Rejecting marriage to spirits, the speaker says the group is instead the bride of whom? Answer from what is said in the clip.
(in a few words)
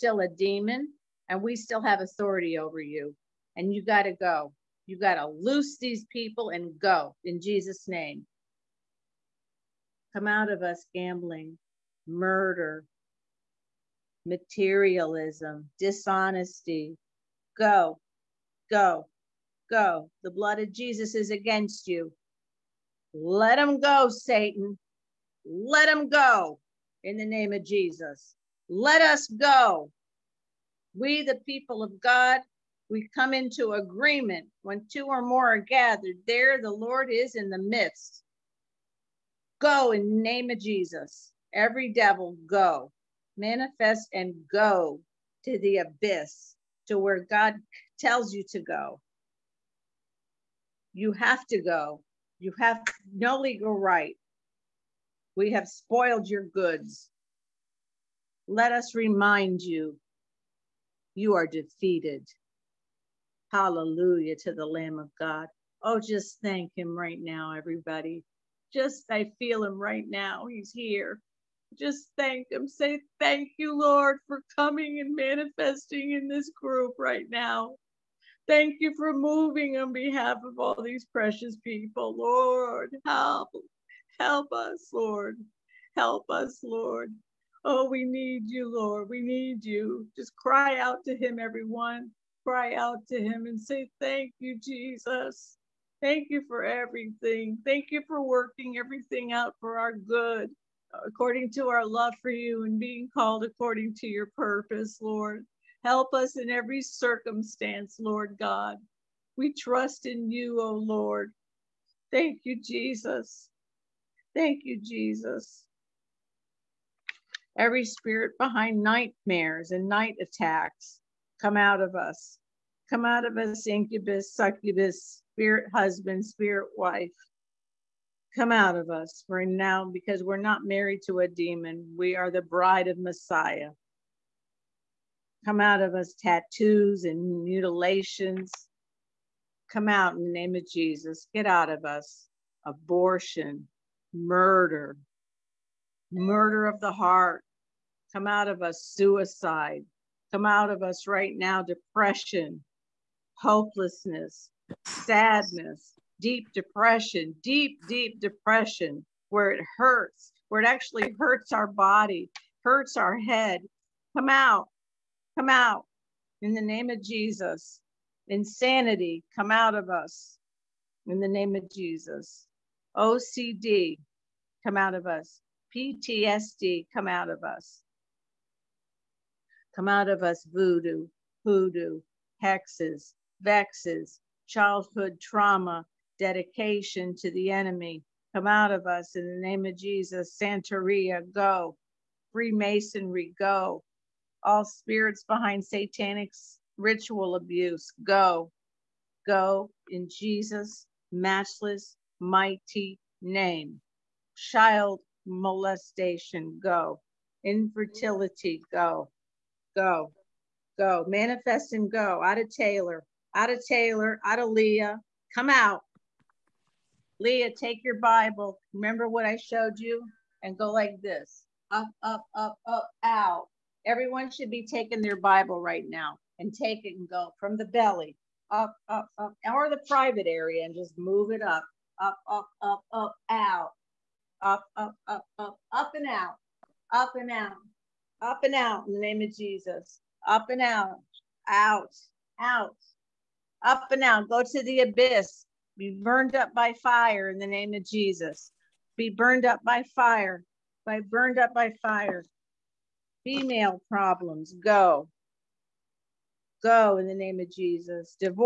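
Messiah.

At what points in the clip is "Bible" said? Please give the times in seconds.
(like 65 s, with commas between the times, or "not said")
217 s, 225 s.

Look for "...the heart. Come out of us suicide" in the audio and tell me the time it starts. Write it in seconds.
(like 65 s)
146 s.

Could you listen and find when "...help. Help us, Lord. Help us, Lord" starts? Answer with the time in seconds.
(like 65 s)
83 s.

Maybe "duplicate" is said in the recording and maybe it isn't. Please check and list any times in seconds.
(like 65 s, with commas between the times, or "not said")
not said.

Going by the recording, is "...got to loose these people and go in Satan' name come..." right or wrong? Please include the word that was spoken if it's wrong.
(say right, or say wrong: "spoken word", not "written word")
wrong: "Jesus", not "Satan".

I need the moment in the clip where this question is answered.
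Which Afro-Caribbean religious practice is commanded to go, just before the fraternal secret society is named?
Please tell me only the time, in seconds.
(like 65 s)
190 s.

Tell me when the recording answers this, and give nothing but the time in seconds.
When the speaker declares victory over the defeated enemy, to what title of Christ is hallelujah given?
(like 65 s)
64 s.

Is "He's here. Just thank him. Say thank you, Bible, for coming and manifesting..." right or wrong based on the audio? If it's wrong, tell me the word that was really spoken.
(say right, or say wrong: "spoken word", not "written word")
wrong: "Lord", not "Bible".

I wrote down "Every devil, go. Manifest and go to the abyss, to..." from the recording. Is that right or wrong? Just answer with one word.
right.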